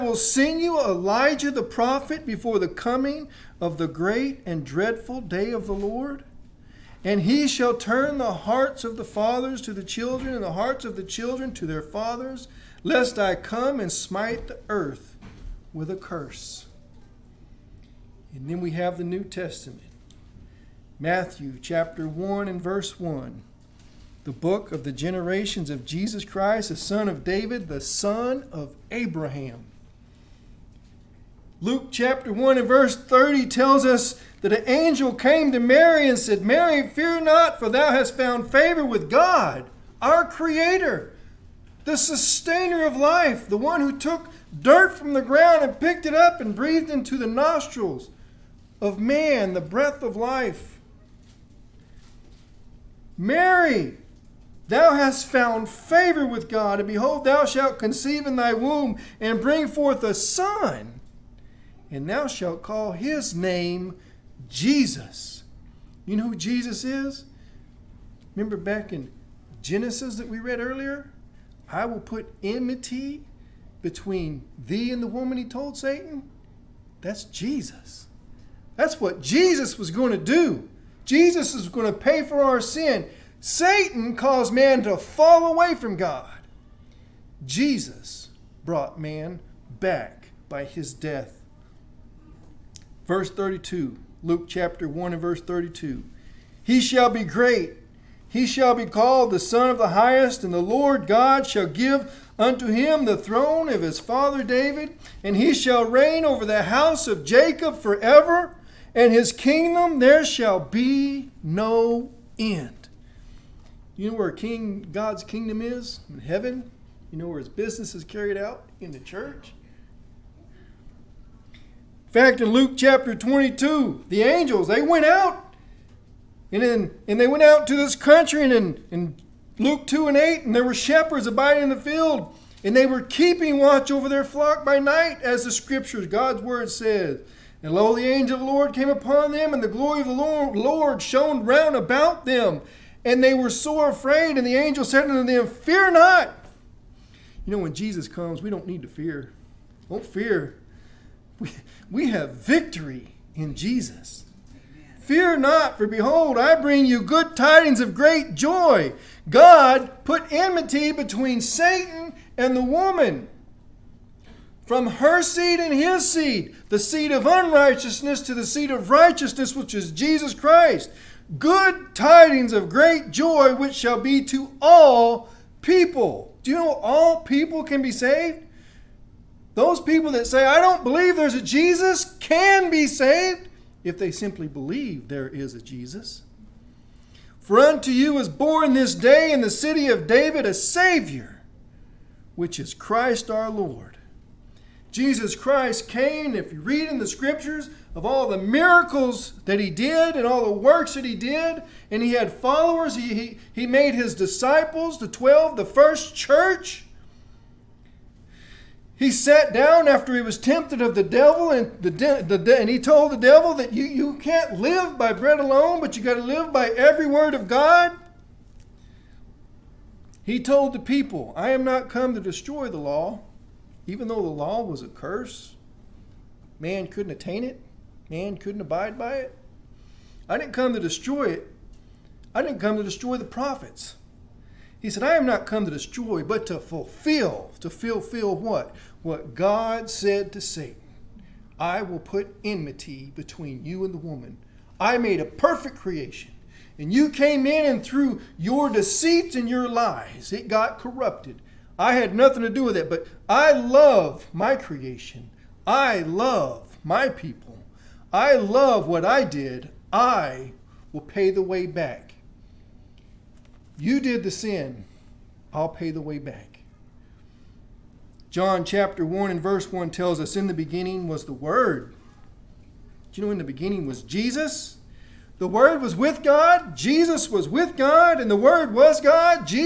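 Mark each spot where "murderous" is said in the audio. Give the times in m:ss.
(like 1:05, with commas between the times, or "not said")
not said.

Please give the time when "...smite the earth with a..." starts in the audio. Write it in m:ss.
0:13.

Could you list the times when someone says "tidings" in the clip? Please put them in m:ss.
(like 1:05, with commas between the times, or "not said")
2:37, 2:51.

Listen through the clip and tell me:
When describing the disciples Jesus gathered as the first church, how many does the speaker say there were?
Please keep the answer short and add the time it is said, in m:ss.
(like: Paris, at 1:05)
12, at 3:24.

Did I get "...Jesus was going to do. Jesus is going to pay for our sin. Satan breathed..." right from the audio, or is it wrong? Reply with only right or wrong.
wrong.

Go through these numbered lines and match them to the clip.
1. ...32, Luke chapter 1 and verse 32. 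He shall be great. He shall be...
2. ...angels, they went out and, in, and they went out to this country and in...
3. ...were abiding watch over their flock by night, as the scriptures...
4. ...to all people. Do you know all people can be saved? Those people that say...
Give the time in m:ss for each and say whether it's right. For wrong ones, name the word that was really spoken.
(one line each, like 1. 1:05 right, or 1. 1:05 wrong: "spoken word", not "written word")
1. 1:33 right
2. 2:04 right
3. 2:12 wrong: "keeping", not "abiding"
4. 2:54 right.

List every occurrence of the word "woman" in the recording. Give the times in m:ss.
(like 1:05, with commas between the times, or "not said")
1:15, 2:42, 4:03.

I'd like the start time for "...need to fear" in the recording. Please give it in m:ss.
2:28.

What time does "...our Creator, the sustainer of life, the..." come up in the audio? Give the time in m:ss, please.
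0:40.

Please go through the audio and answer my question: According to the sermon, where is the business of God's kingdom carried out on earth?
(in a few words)
In the church.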